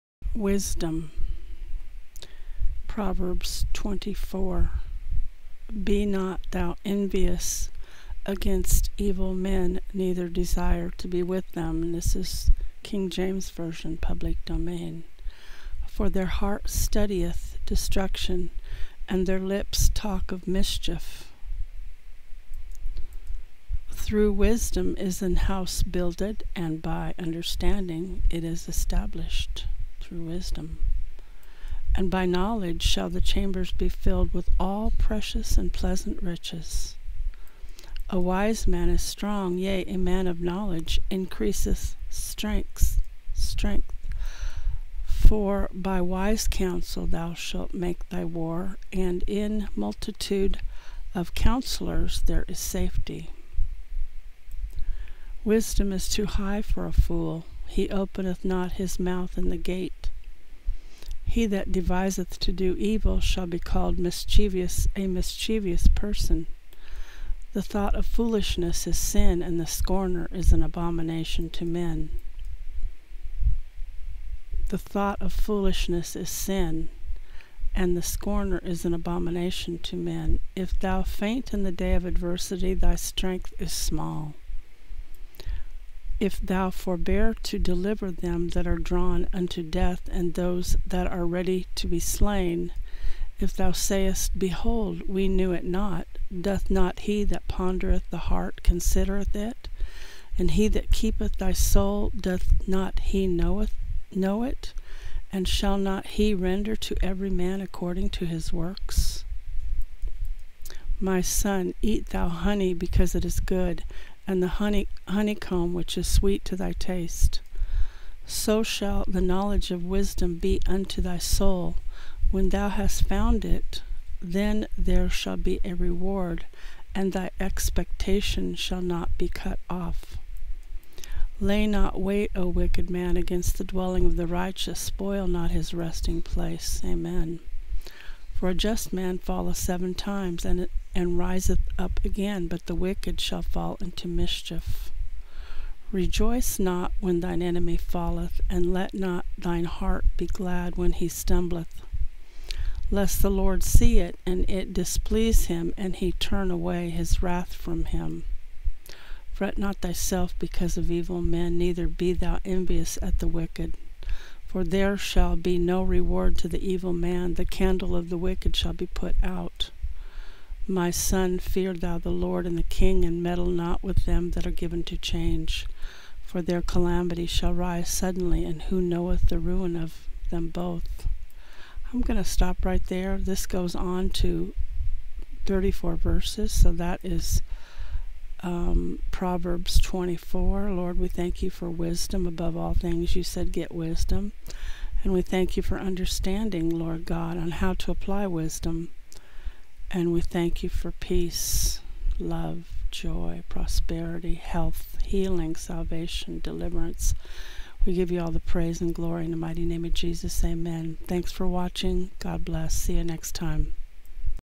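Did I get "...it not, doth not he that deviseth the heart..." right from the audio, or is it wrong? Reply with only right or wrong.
wrong.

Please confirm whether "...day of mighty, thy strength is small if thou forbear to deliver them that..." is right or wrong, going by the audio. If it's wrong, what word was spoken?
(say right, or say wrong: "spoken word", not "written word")
wrong: "adversity", not "mighty".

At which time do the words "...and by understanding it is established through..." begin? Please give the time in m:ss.
0:26.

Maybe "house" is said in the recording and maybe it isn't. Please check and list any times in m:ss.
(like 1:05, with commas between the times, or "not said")
0:25.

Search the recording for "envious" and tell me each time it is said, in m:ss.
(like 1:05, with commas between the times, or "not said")
0:06, 2:42.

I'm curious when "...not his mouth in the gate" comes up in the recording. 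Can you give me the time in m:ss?
0:58.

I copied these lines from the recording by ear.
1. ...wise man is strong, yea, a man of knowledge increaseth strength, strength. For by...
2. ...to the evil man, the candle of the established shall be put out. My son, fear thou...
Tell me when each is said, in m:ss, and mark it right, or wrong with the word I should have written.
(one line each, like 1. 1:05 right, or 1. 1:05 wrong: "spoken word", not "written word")
1. 0:38 right
2. 2:46 wrong: "wicked", not "established".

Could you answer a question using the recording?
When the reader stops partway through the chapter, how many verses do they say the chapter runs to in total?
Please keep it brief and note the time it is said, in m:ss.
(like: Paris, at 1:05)
34, at 3:05.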